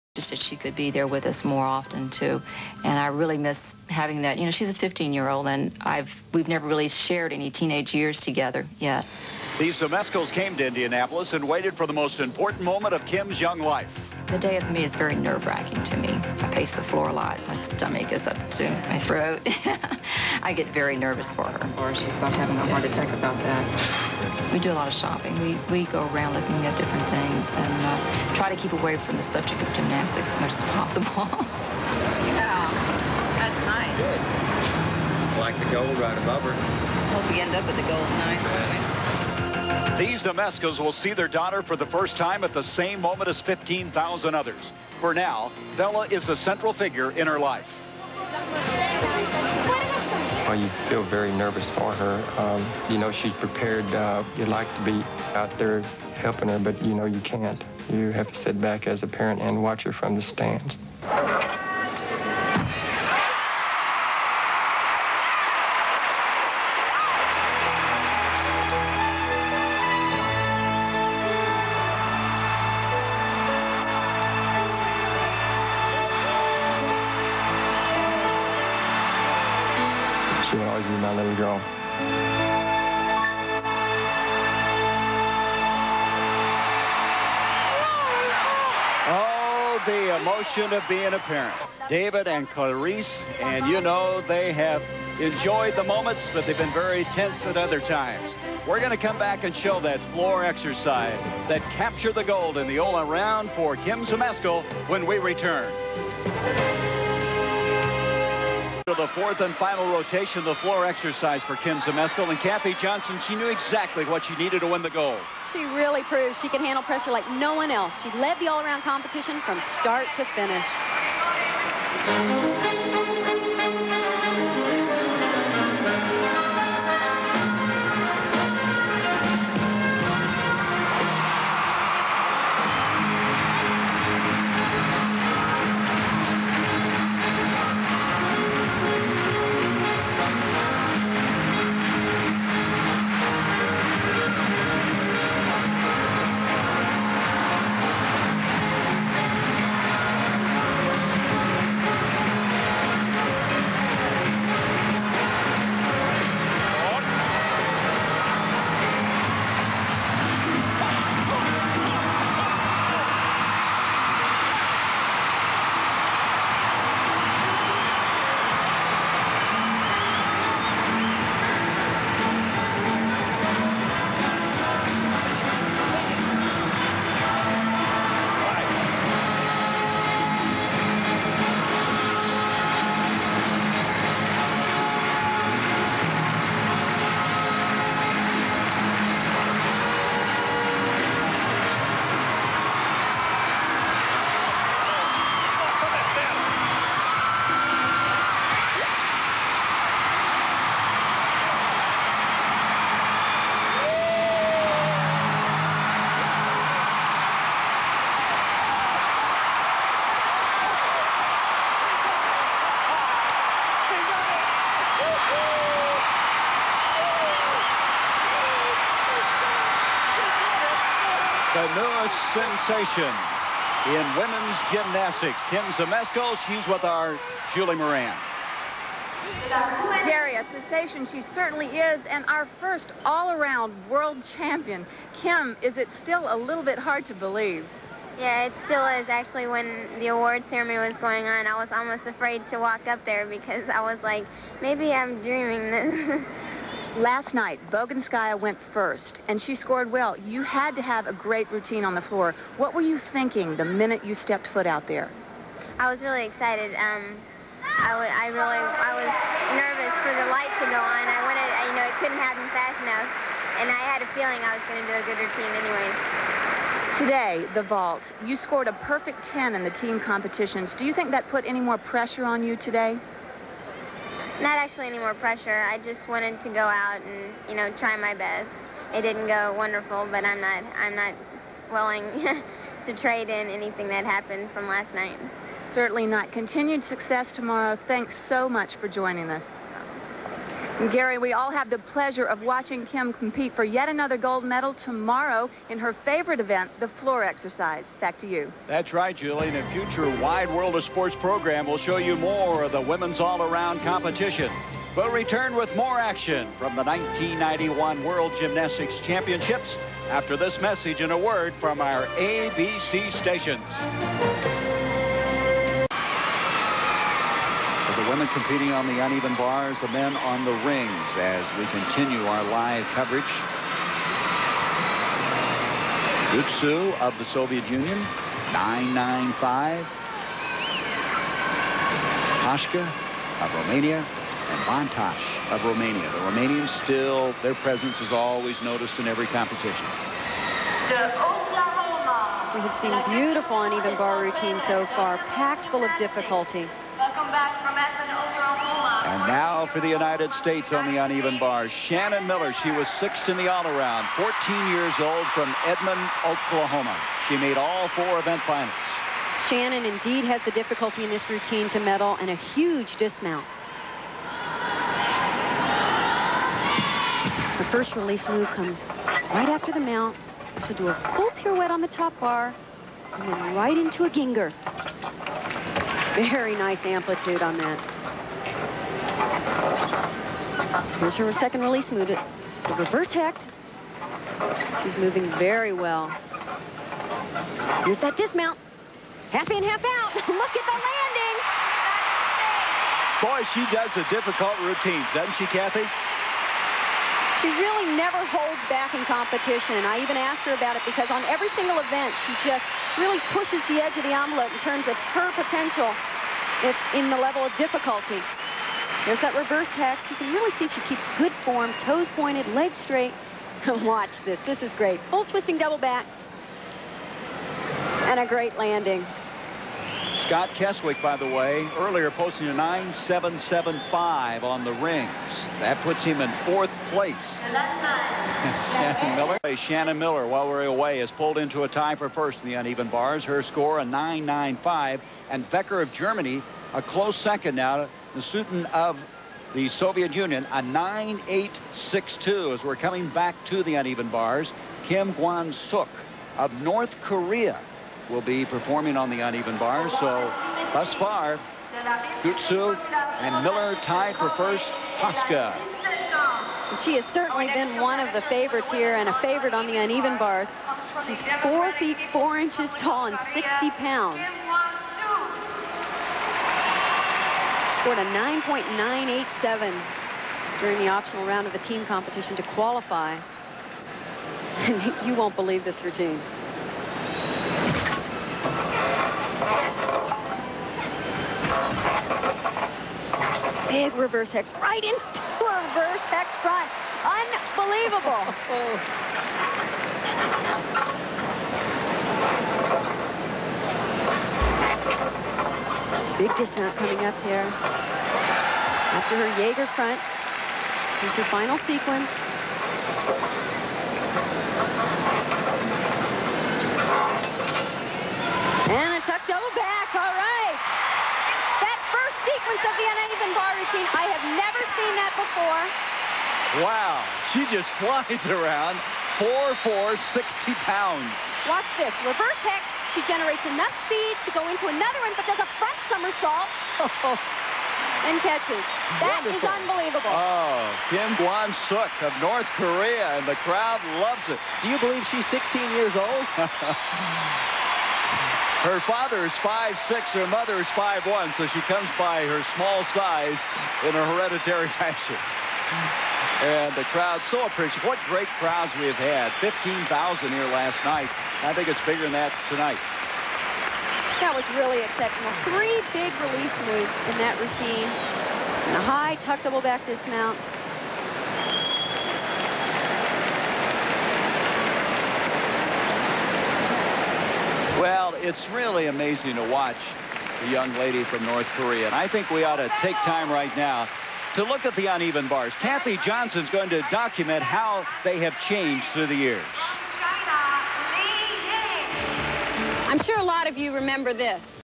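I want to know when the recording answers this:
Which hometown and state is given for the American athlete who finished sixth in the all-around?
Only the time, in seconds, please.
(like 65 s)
355 s.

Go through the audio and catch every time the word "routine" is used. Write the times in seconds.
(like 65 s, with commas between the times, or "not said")
251 s, 265 s, 344 s, 361 s, 394 s, 475 s, 513 s, 557 s.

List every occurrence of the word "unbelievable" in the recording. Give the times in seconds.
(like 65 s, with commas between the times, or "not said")
487 s, 529 s.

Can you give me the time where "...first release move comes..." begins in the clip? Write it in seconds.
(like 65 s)
367 s.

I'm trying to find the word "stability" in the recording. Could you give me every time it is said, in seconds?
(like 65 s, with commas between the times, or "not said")
not said.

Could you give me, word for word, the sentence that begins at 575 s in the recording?
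Kathy Johnson's going to document how they have changed through the years.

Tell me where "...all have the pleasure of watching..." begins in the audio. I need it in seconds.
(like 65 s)
291 s.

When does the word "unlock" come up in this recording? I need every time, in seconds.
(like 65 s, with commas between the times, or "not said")
not said.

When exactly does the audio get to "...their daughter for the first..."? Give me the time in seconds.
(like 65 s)
41 s.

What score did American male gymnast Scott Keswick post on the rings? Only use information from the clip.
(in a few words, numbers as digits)
9.775.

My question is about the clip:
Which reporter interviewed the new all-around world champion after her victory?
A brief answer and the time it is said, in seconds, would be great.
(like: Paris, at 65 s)
Julie Moran, at 227 s.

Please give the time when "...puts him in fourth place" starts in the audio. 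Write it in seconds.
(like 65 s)
425 s.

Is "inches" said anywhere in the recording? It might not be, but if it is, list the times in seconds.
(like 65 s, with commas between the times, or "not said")
462 s.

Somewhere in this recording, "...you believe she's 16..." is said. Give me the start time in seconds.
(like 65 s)
534 s.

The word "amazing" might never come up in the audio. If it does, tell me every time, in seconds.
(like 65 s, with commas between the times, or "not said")
568 s.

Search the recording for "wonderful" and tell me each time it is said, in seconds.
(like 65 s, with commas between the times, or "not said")
279 s, 529 s.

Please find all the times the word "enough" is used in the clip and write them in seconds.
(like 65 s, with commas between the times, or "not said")
262 s, 523 s.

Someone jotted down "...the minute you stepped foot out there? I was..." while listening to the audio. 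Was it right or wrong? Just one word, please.
right.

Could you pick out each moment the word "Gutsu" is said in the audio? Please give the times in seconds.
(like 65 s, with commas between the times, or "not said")
326 s, 452 s.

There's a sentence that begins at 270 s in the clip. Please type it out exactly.
Do you think that put any more pressure on you today?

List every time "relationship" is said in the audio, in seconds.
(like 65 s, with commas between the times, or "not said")
not said.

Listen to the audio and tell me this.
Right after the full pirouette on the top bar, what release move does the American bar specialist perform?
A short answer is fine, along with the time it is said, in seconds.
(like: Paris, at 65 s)
Gienger, at 374 s.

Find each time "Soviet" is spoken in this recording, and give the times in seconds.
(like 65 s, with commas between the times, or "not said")
327 s, 439 s.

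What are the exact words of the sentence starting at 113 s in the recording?
She knew exactly what she needed to win the goal.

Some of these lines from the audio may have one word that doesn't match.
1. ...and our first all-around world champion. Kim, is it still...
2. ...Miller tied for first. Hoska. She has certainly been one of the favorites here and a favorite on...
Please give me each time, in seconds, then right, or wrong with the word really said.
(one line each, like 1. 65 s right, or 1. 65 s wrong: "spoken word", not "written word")
1. 232 s right
2. 453 s right.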